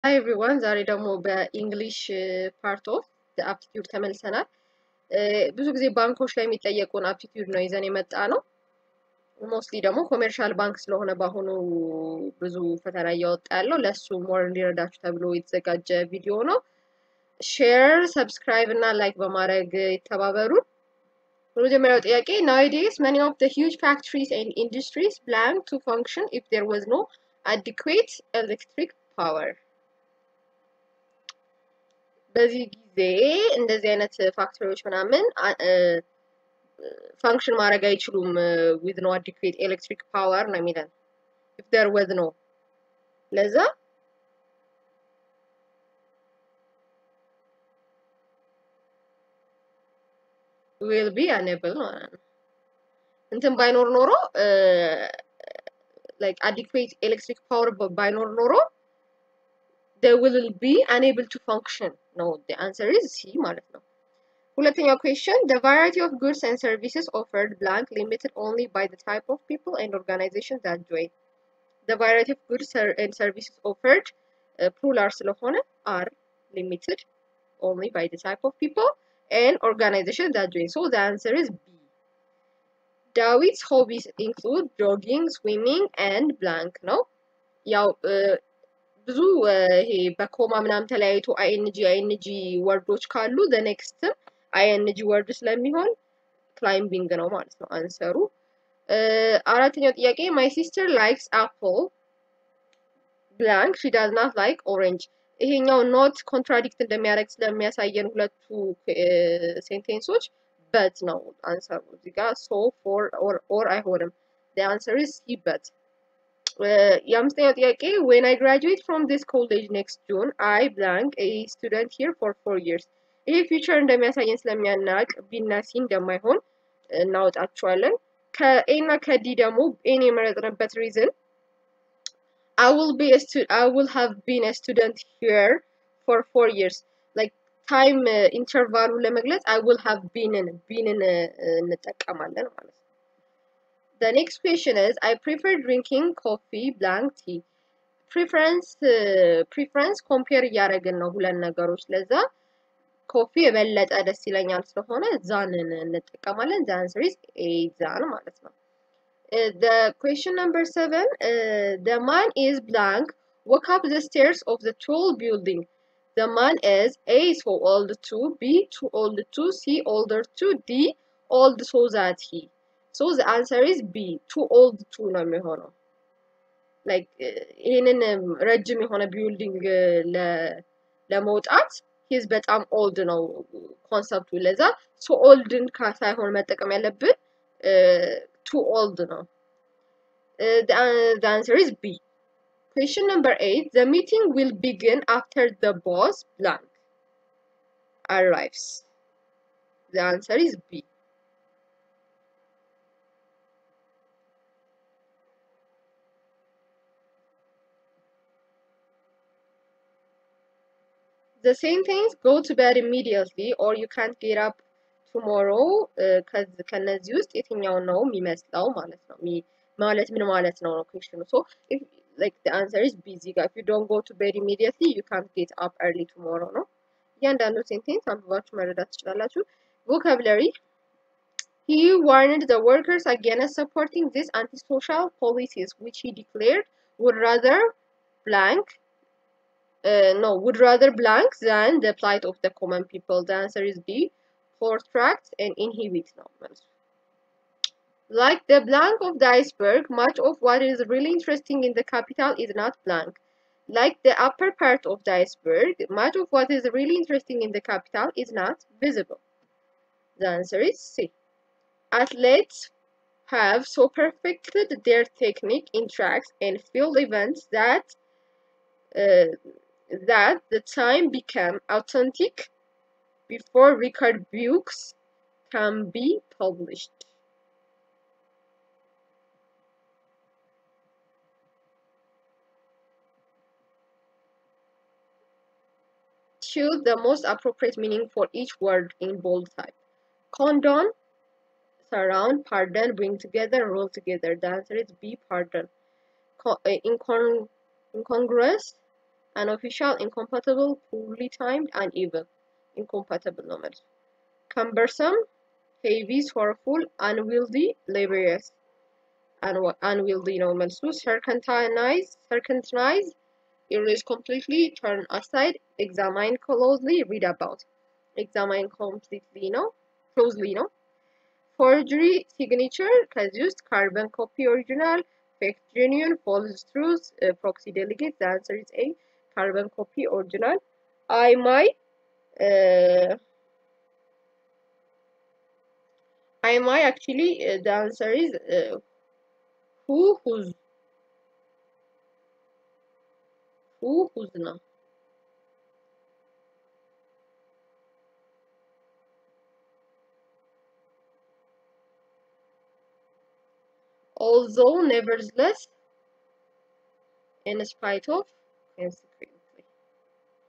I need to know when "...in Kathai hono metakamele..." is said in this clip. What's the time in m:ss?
3:05.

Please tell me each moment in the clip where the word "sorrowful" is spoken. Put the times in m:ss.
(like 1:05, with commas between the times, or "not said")
5:06.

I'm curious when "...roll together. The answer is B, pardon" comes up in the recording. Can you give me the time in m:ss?
4:53.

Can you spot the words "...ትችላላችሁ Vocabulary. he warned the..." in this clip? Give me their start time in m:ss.
3:48.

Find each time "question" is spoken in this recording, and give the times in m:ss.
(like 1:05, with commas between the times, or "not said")
1:05, 2:24, 2:39, 3:12.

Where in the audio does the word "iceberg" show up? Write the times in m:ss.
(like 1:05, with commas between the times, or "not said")
4:09, 4:15.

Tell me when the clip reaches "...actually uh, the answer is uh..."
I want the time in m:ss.
5:36.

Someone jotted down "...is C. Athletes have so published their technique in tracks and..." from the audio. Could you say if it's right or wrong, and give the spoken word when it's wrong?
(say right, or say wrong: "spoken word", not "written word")
wrong: "perfected", not "published".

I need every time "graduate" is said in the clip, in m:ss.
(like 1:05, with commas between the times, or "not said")
1:58.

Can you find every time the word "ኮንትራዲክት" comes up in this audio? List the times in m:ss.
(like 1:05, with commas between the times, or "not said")
1:46.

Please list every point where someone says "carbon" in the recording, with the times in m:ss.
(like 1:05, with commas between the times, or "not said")
5:23, 5:29.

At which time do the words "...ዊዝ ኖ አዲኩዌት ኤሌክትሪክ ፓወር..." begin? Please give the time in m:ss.
0:38.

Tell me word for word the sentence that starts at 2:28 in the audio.
Preference, uh, preference compare yaragin na hulan nagarush leza.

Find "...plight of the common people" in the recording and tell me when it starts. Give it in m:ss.
4:01.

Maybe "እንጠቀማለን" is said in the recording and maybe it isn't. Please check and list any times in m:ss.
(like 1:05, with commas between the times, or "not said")
2:21.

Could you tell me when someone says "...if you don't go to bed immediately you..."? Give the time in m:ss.
3:43.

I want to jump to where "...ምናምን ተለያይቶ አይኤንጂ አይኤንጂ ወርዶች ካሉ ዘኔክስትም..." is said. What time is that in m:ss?
1:30.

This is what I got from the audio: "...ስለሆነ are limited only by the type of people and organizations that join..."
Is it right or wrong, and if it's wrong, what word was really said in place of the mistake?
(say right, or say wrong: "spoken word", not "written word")
right.